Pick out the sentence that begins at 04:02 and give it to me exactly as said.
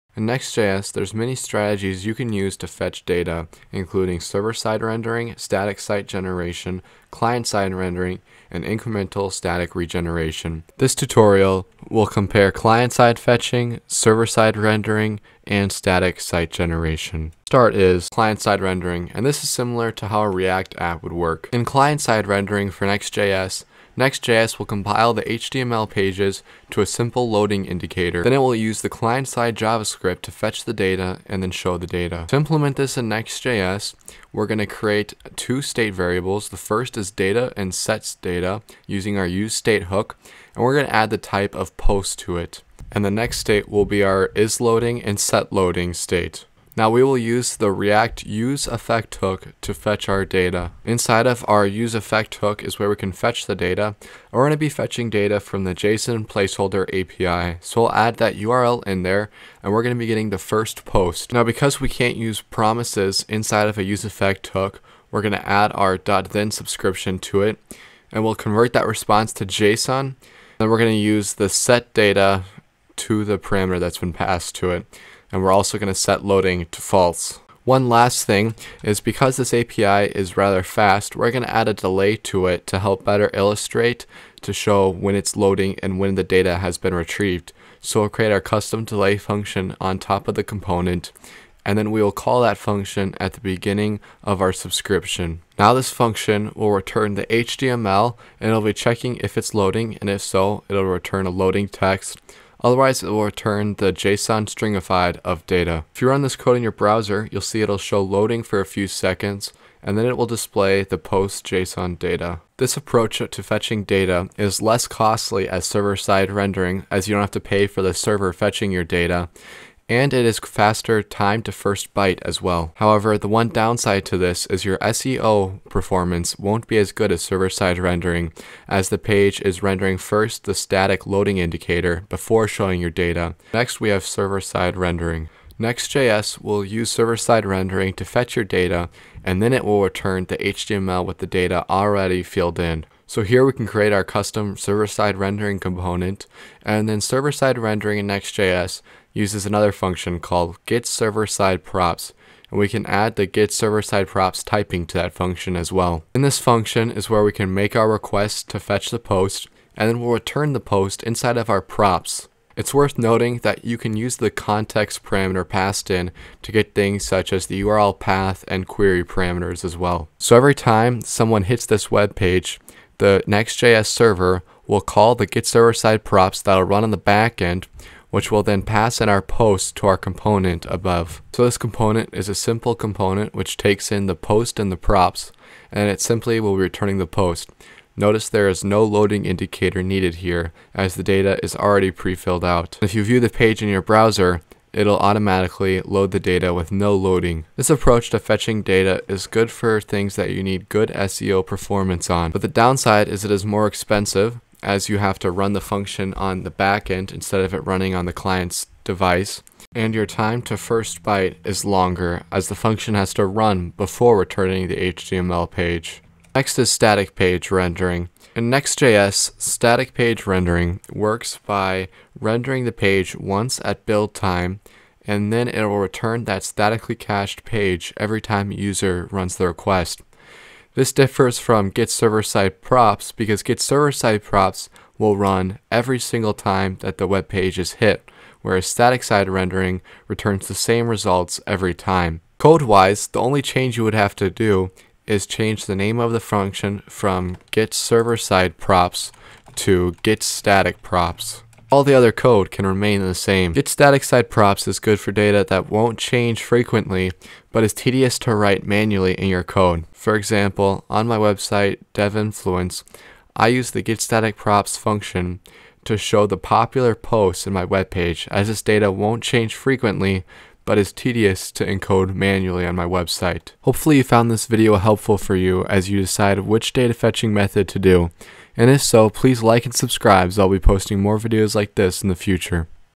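Code-wise, the only change you would have to do is change the name of the function from getServerSideProps to getStaticProps.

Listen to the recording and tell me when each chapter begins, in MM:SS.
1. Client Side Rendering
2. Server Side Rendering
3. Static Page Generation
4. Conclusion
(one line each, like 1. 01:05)
1. 00:16
2. 02:14
3. 03:36
4. 04:34.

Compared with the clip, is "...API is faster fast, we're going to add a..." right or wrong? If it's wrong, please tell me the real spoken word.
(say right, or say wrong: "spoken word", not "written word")
wrong: "rather", not "faster".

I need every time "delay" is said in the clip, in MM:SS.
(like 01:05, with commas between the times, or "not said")
01:21, 01:28.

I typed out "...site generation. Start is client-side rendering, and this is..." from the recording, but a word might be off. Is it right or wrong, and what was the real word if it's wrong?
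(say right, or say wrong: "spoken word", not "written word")
right.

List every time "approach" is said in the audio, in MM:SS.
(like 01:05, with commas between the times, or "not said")
01:52, 03:17.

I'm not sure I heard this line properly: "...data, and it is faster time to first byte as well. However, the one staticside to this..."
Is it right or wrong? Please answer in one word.
wrong.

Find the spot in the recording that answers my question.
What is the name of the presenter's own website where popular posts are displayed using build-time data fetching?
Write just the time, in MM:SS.
04:21.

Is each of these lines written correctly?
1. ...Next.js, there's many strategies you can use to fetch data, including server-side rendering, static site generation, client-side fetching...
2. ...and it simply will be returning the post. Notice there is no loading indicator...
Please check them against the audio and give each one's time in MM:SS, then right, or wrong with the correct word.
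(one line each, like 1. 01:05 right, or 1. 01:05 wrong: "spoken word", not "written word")
1. 00:00 wrong: "rendering", not "fetching"
2. 03:05 right.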